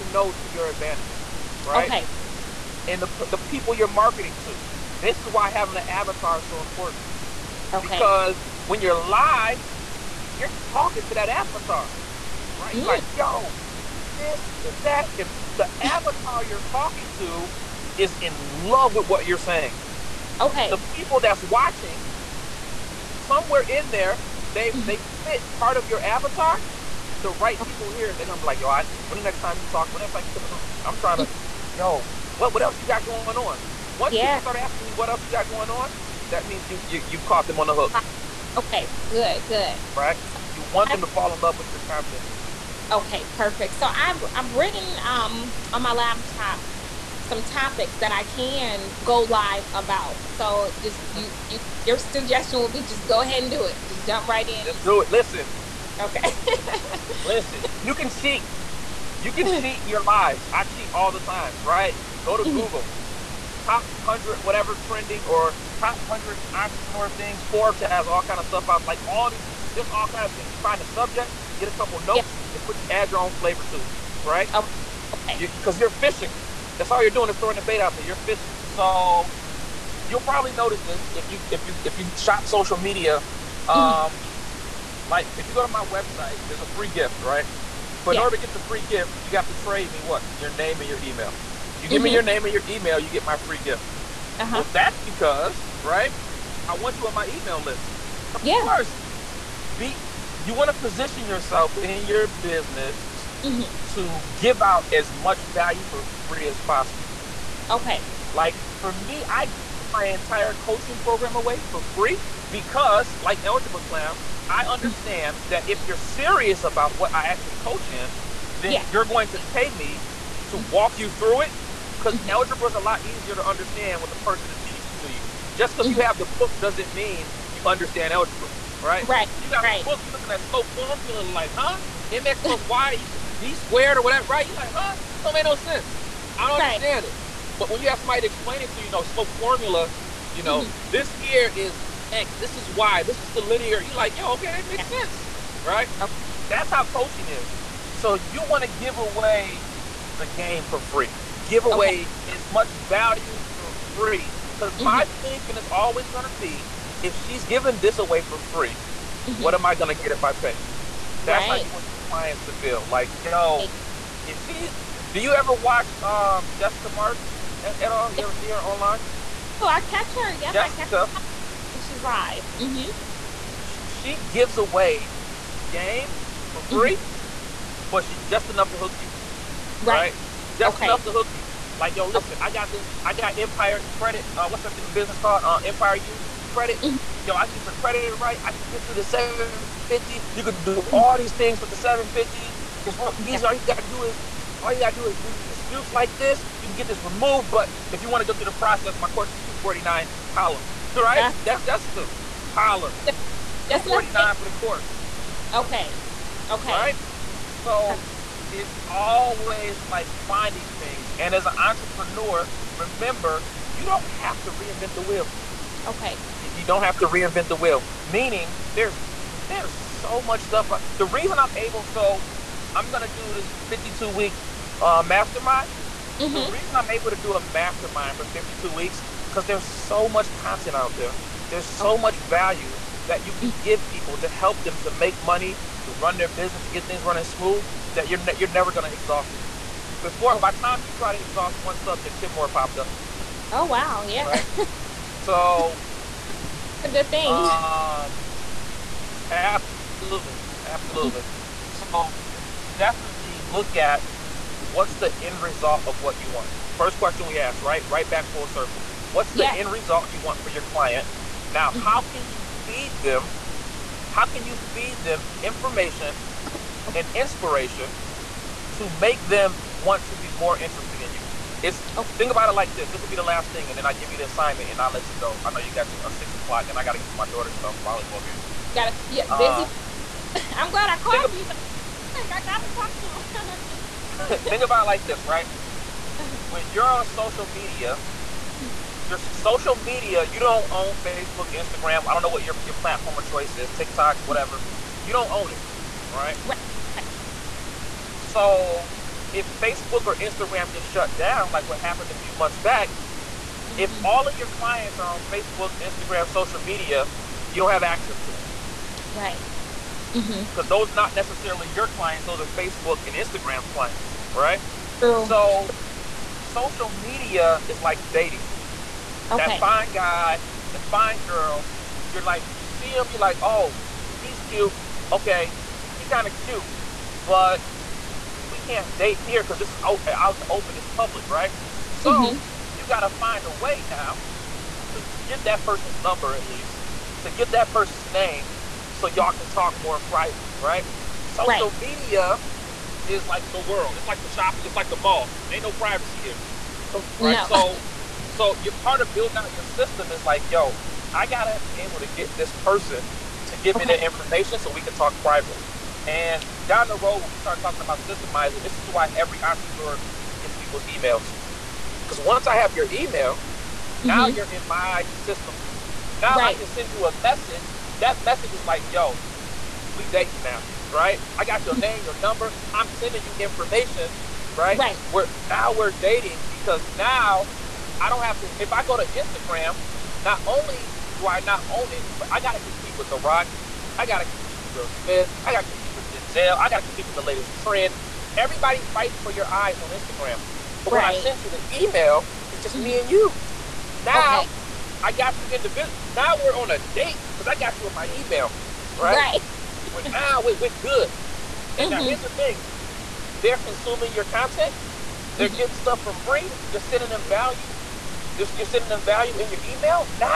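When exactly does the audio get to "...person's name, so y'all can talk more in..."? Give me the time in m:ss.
5:37.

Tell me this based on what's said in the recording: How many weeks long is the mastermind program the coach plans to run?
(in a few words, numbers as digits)
52.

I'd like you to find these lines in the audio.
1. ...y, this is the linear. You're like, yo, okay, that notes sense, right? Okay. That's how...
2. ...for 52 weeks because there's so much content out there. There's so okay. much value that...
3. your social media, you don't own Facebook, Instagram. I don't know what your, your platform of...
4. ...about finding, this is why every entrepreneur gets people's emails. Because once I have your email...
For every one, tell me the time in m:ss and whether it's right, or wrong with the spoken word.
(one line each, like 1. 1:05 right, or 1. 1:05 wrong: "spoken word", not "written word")
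1. 2:22 wrong: "makes", not "notes"
2. 3:48 right
3. 4:49 right
4. 5:57 wrong: "systemizing", not "finding".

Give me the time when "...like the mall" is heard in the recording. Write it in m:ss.
5:44.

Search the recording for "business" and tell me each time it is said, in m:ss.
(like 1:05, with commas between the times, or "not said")
1:42, 3:04, 3:56.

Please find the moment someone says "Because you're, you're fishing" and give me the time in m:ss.
1:15.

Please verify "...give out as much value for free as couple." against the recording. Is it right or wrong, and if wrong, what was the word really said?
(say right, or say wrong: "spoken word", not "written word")
wrong: "possible", not "couple".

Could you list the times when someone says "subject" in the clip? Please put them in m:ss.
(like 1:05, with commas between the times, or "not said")
1:10, 4:01.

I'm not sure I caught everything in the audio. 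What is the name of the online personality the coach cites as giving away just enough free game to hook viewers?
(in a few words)
Jessica Martin.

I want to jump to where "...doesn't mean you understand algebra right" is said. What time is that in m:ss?
2:06.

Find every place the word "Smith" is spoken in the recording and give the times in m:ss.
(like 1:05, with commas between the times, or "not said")
6:24.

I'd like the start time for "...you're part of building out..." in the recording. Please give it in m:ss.
5:48.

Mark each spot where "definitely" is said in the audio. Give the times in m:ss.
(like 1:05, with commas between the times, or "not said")
4:12.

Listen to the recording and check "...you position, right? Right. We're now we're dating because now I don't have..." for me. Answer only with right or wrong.
wrong.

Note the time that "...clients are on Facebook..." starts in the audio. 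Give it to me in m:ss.
5:04.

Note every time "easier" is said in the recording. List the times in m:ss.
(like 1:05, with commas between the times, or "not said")
2:03.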